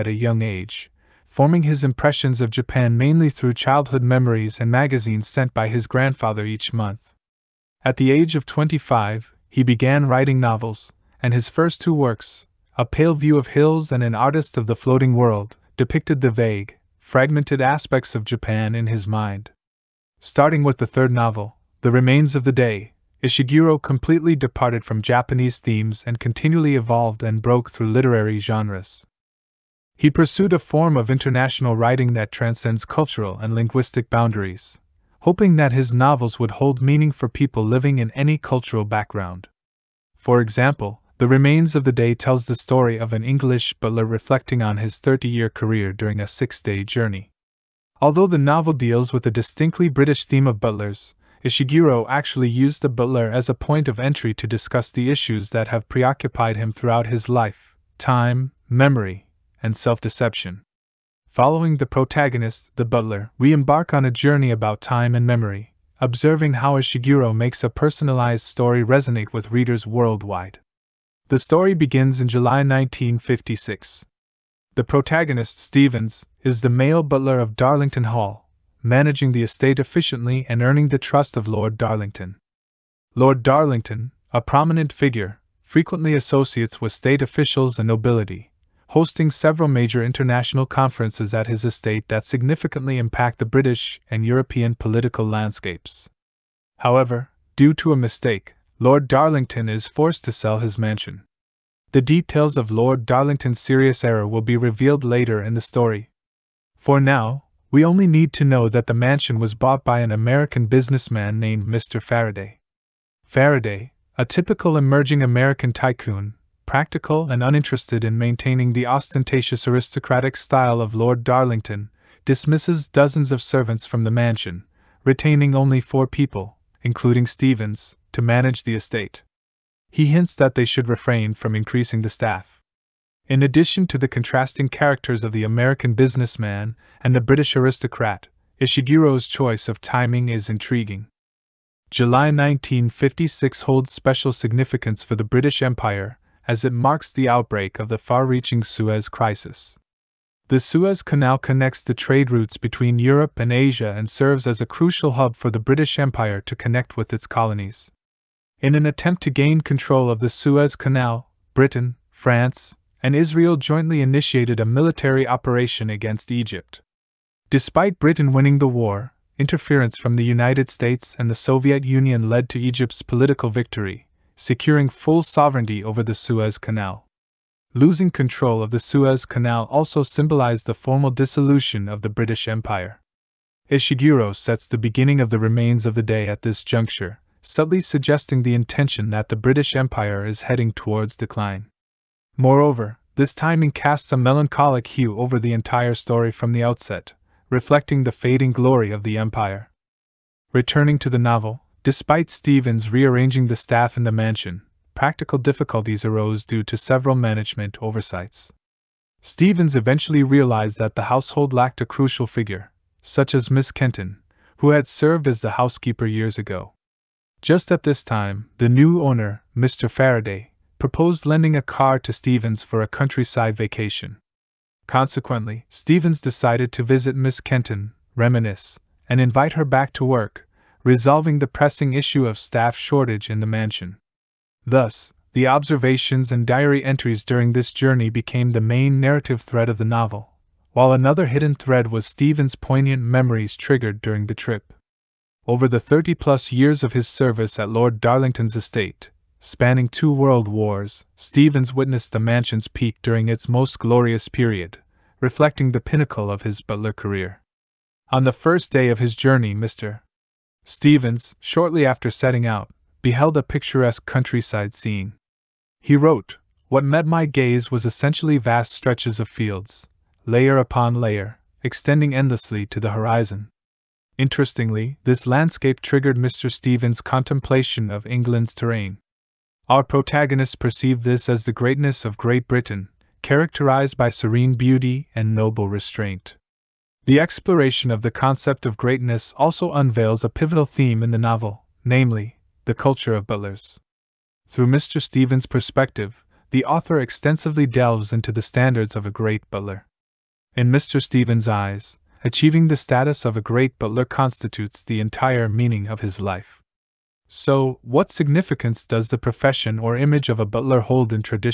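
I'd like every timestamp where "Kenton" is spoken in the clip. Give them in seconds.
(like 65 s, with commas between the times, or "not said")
213 s, 227 s.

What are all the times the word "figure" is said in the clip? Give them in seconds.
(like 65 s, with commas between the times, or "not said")
84 s, 212 s.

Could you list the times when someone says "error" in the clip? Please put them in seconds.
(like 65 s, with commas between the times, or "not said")
104 s.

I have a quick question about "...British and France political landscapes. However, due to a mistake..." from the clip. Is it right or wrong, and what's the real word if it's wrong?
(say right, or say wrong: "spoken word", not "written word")
wrong: "European", not "France".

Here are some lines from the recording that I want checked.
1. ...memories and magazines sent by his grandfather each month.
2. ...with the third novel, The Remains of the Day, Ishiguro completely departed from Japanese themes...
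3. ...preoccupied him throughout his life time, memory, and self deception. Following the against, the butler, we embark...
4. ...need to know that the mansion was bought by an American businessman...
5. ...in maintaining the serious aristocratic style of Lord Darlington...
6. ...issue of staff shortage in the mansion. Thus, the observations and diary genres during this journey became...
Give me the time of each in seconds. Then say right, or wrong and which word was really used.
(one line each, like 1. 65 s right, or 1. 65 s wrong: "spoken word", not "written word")
1. 4 s right
2. 20 s right
3. 55 s wrong: "protagonist", not "against"
4. 108 s right
5. 118 s wrong: "ostentatious", not "serious"
6. 231 s wrong: "entries", not "genres".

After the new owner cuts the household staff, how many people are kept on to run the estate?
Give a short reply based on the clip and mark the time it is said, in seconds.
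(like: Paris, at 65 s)
4, at 125 s.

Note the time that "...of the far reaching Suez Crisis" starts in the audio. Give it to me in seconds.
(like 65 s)
147 s.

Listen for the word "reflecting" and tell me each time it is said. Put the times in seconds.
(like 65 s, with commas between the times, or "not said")
44 s, 197 s, 255 s.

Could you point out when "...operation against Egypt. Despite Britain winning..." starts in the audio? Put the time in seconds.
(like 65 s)
165 s.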